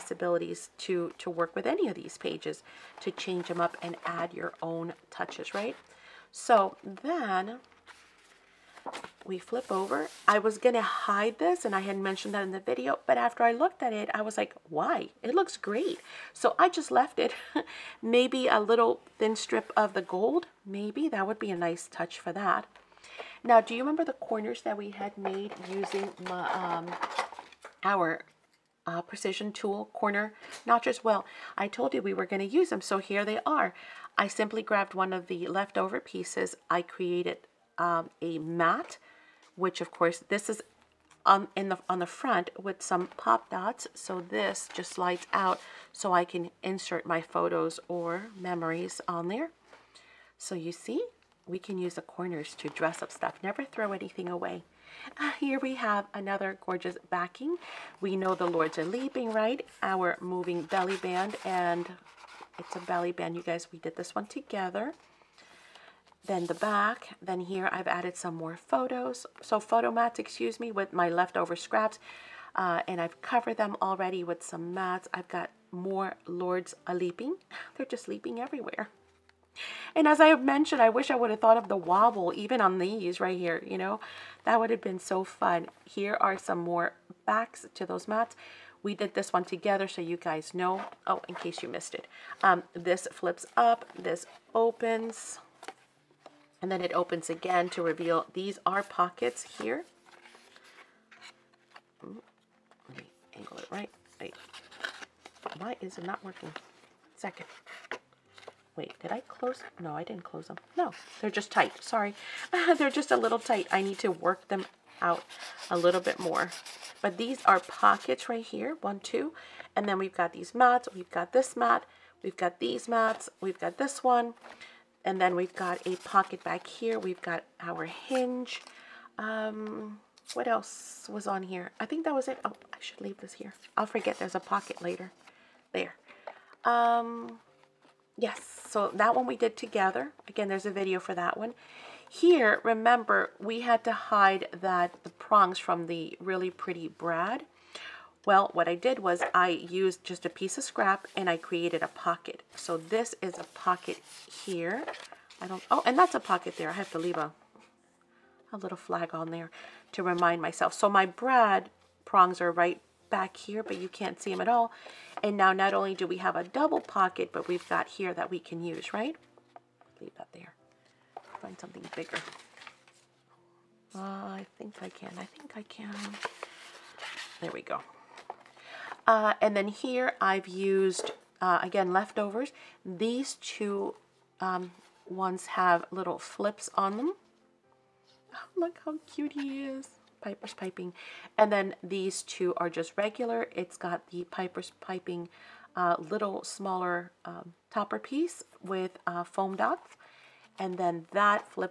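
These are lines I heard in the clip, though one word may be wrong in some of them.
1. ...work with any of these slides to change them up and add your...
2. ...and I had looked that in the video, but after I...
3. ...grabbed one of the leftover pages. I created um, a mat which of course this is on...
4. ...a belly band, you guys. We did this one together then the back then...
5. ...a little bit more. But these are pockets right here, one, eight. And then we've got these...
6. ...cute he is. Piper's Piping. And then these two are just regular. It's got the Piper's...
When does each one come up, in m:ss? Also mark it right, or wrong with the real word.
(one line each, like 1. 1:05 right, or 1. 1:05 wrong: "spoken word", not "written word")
1. 0:01 wrong: "pages", not "slides"
2. 0:11 wrong: "mentioned", not "looked"
3. 0:34 wrong: "pieces", not "pages"
4. 1:02 right
5. 1:55 wrong: "two", not "eight"
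6. 3:09 right.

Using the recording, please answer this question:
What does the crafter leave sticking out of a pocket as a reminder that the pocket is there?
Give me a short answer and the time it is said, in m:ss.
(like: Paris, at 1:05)
a little flag, at 2:38.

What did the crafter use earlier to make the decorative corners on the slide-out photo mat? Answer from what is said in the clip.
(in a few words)
precision tool corner notches.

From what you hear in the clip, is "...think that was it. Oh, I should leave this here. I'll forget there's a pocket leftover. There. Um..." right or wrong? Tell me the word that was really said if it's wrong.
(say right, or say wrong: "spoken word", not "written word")
wrong: "later", not "leftover".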